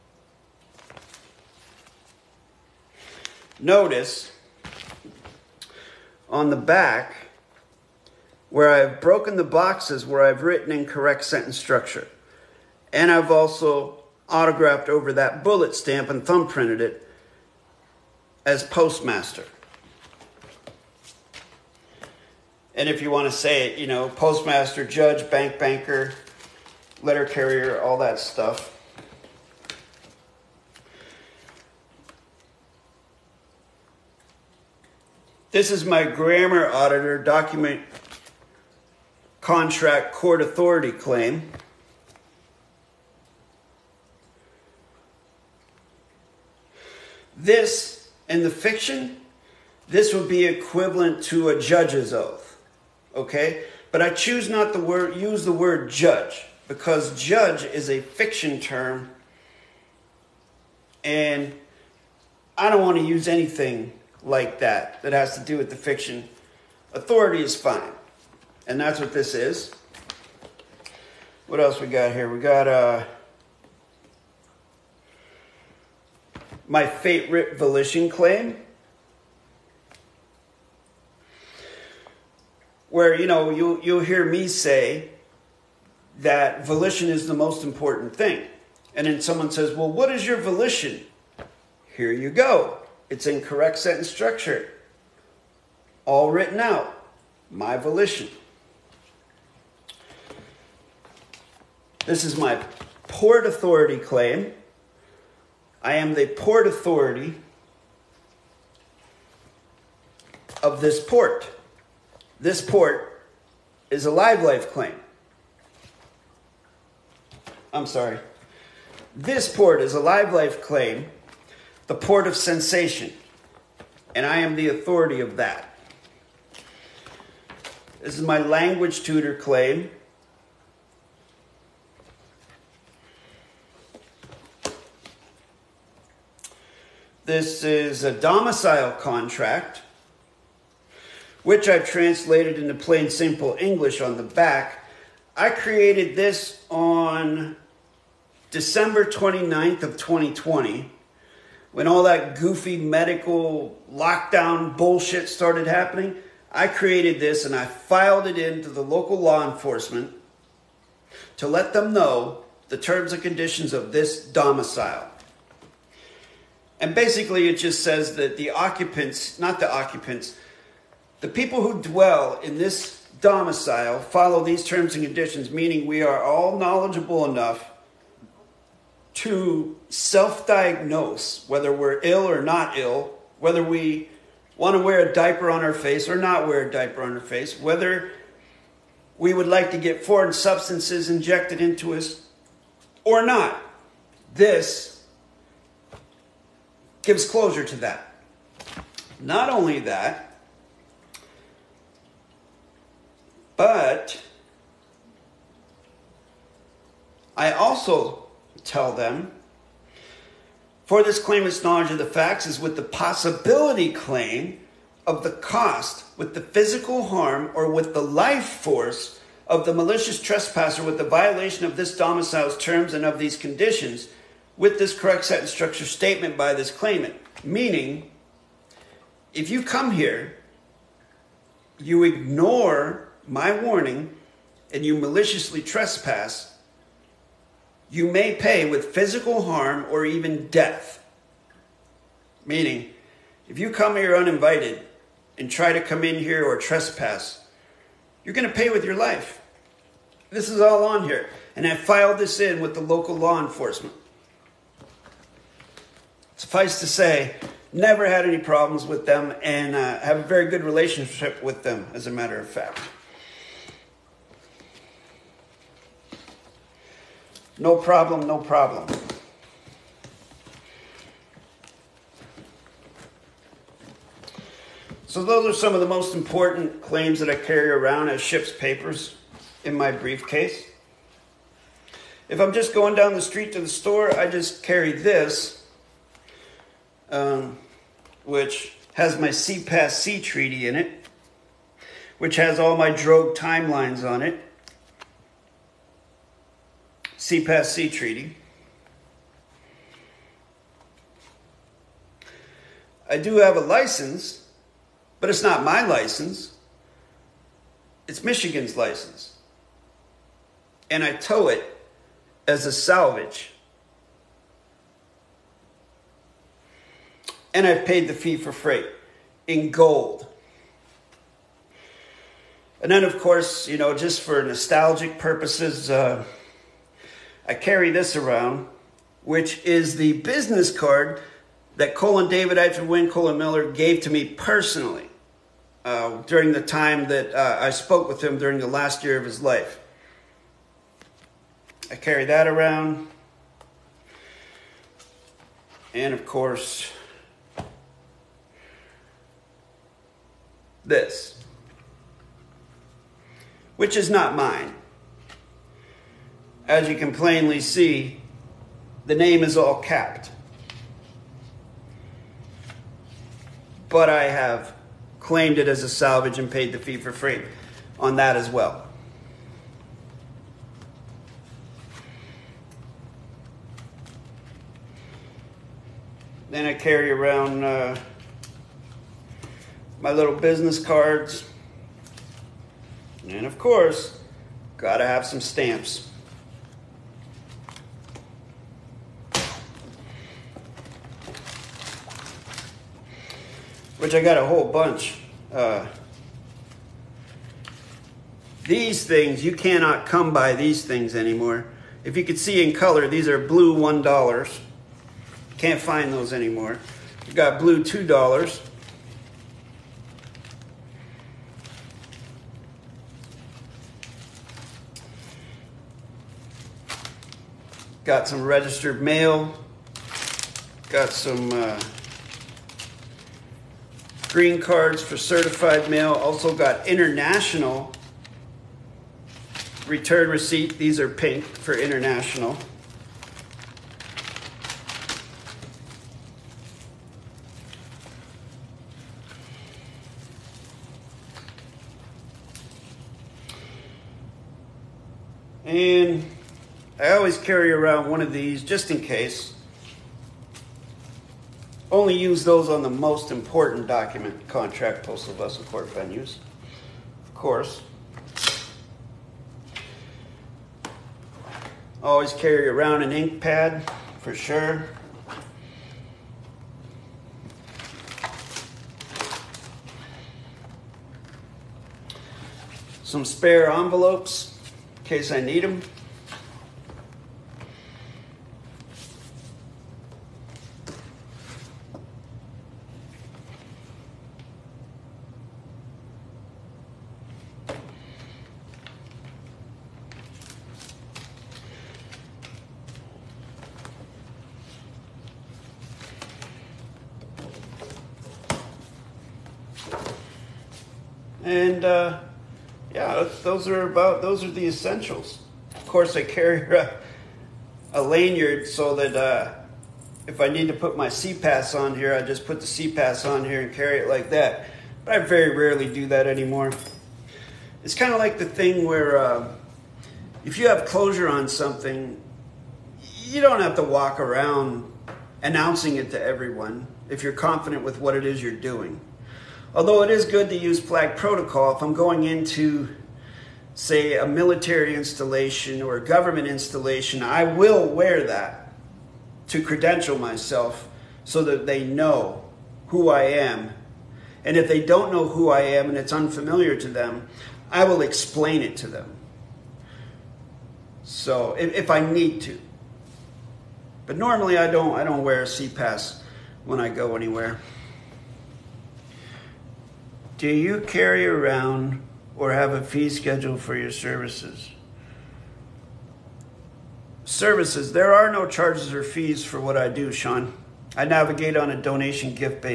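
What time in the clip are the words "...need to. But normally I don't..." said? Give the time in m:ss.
9:11.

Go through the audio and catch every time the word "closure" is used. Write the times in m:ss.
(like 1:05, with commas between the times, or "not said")
3:17, 8:40.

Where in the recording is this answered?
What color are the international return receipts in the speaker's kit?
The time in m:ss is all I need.
7:10.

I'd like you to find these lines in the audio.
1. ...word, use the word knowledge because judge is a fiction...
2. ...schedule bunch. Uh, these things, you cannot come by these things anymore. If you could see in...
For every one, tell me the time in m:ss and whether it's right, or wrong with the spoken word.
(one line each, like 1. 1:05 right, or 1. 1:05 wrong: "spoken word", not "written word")
1. 0:54 wrong: "judge", not "knowledge"
2. 6:34 wrong: "whole", not "schedule".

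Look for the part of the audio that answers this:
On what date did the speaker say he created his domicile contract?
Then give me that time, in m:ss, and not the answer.
2:28.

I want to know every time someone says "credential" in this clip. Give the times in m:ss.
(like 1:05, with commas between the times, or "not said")
8:59.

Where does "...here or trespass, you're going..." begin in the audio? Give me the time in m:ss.
4:06.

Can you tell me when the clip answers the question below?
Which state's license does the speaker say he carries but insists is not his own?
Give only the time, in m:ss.
5:08.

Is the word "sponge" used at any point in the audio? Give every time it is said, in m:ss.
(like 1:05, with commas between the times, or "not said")
not said.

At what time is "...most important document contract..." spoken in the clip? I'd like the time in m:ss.
7:32.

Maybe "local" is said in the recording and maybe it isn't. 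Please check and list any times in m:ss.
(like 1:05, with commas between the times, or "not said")
2:38, 4:12.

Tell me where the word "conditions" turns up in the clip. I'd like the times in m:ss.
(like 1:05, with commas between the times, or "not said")
2:43, 2:55, 3:43.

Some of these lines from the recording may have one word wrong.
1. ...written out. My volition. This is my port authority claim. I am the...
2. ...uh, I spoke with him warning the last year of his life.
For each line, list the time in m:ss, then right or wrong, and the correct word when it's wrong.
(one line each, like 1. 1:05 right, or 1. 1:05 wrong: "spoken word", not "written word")
1. 1:36 right
2. 5:37 wrong: "during", not "warning".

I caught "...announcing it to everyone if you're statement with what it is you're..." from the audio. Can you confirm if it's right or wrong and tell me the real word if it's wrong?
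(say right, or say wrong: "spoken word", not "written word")
wrong: "confident", not "statement".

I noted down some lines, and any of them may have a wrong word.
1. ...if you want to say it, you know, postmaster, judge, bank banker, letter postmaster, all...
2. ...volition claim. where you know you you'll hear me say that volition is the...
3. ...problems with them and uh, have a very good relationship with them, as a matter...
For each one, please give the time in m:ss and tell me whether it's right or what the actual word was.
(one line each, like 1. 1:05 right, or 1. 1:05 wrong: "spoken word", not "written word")
1. 0:22 wrong: "carrier", not "postmaster"
2. 1:17 right
3. 4:18 right.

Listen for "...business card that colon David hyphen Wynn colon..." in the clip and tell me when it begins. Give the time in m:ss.
5:30.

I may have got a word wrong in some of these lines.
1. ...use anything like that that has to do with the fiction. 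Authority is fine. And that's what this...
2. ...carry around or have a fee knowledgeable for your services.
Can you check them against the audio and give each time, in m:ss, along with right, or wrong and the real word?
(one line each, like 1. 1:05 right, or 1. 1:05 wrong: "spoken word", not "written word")
1. 1:03 right
2. 9:20 wrong: "schedule", not "knowledgeable".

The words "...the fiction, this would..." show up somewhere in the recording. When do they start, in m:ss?
0:48.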